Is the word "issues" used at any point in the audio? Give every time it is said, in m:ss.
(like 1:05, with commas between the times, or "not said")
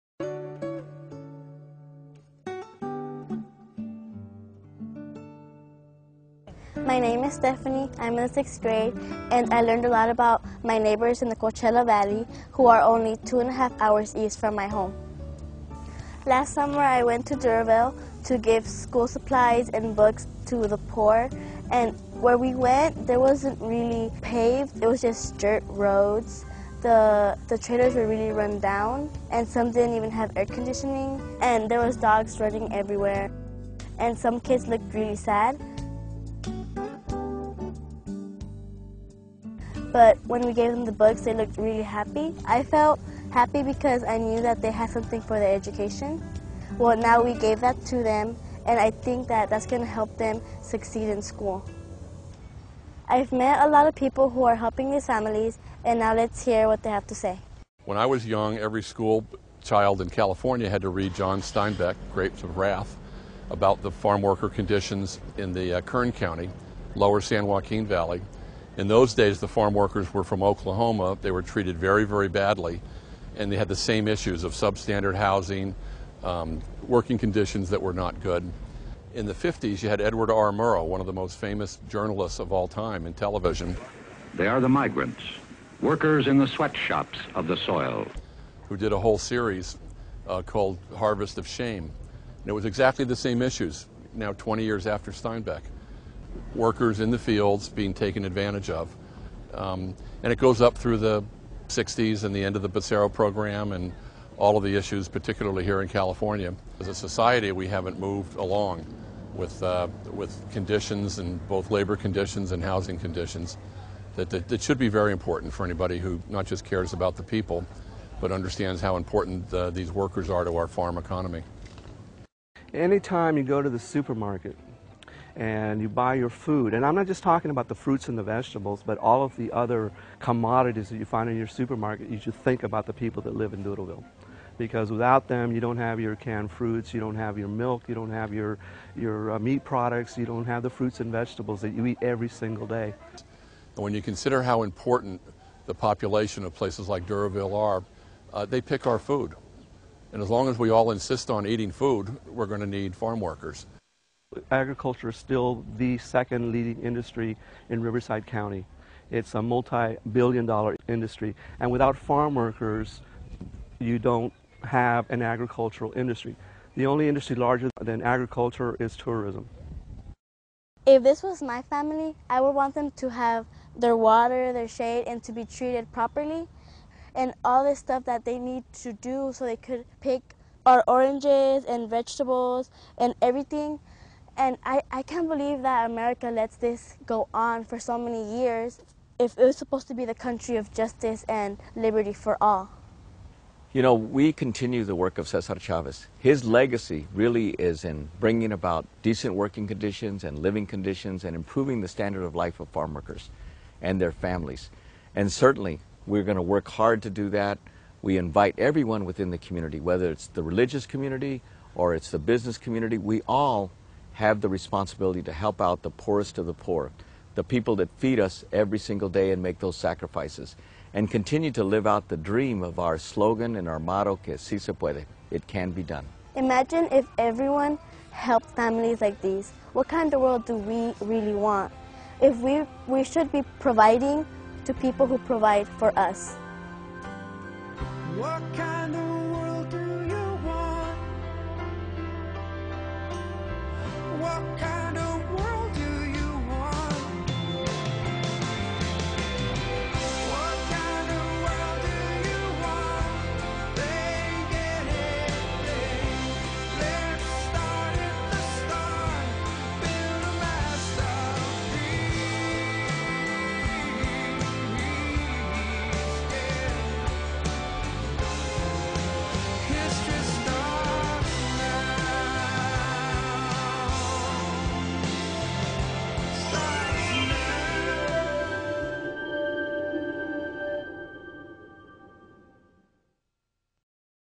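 1:14, 1:33, 1:44.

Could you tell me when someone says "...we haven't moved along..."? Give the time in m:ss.
1:47.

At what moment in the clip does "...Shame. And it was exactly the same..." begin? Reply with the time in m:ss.
1:31.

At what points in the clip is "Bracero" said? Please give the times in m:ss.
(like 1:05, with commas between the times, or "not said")
1:42.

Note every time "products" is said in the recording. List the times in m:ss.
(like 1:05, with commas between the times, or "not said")
2:19.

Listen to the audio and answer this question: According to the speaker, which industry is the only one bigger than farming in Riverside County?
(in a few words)
Tourism.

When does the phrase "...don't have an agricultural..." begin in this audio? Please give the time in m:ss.
2:43.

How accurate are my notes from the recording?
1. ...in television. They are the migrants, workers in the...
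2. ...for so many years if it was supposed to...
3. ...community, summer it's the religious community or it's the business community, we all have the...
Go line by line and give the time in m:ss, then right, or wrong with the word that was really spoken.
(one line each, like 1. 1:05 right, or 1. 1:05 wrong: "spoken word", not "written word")
1. 1:23 right
2. 3:07 right
3. 3:29 wrong: "whether", not "summer".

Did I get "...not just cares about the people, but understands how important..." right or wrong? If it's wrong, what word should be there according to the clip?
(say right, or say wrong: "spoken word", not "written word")
right.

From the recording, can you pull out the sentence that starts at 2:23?
When you consider how important the population of places like Duroville are, uh, they pick our food.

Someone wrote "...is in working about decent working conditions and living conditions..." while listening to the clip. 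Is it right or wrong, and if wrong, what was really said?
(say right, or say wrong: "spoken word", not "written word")
wrong: "bringing", not "working".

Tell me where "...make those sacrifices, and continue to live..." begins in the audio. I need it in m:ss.
3:39.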